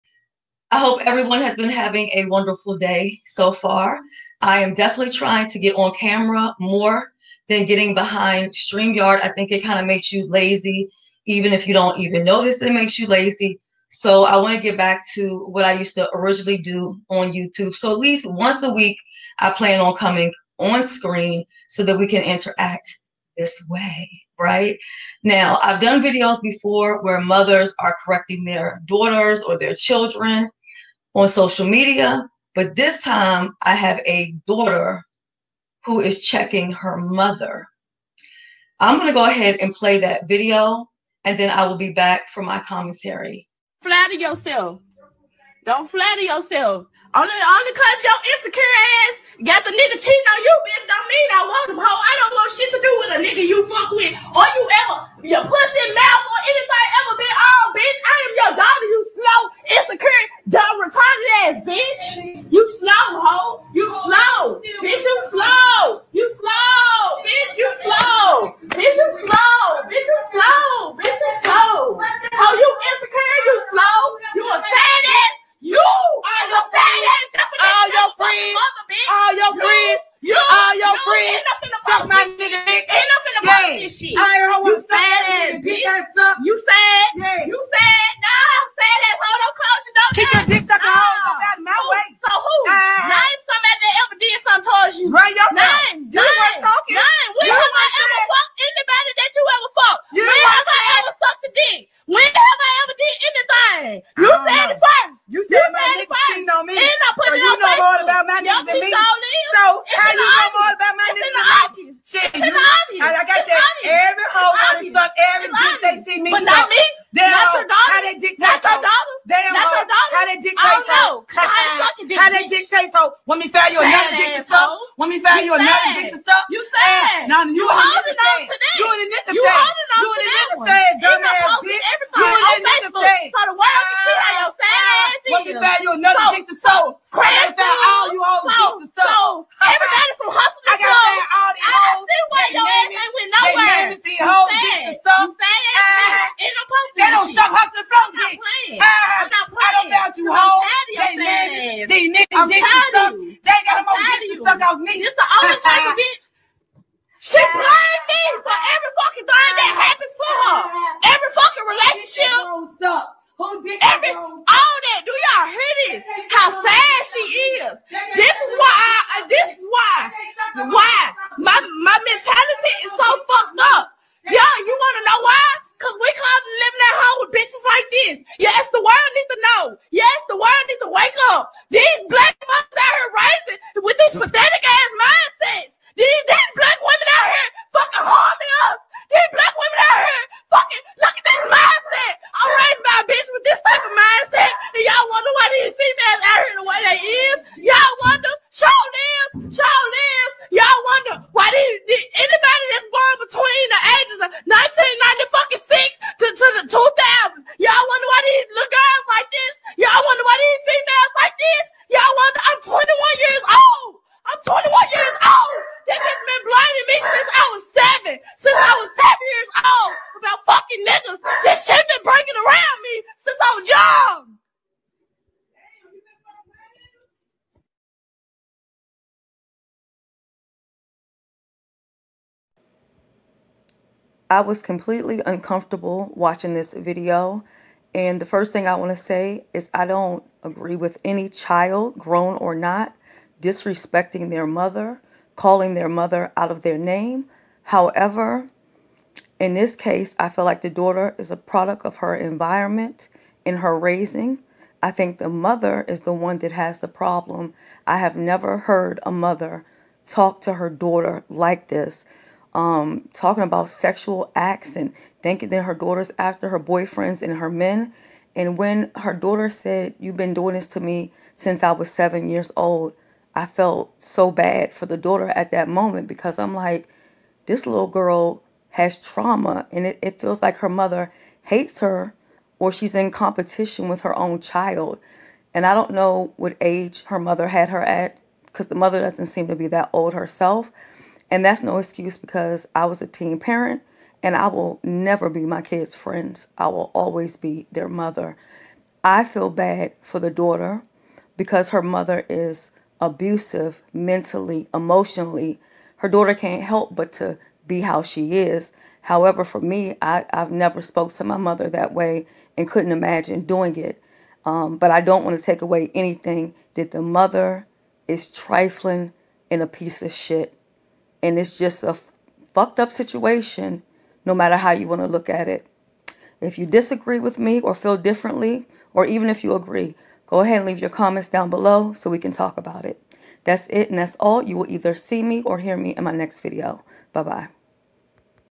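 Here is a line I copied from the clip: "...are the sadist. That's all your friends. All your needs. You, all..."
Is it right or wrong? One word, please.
wrong.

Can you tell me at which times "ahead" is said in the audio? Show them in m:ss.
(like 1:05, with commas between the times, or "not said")
0:39, 5:30.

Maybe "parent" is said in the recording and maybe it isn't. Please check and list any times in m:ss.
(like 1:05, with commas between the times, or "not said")
4:53.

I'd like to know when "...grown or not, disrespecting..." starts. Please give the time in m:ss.
4:01.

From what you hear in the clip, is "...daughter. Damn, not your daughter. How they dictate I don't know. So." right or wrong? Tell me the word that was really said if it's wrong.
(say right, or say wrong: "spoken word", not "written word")
right.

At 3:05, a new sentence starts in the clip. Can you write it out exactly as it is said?
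These, these black women out here fucking harming us.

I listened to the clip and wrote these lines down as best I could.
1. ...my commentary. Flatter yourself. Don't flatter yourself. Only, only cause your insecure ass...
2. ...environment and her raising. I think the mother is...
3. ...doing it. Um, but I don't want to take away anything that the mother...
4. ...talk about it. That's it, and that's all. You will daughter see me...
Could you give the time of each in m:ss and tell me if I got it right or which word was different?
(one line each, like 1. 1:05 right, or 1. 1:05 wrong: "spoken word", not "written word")
1. 0:42 right
2. 4:12 right
3. 5:13 right
4. 5:32 wrong: "either", not "daughter".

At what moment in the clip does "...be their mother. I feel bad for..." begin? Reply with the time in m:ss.
4:57.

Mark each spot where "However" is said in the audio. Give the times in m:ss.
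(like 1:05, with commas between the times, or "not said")
4:07, 5:09.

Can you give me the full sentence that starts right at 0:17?
So at least once a week, I plan on coming on screen so that we can interact this way, right?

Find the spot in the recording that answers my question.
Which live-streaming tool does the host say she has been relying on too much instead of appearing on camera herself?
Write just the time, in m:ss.
0:08.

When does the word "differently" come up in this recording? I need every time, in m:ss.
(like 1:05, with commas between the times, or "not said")
5:27.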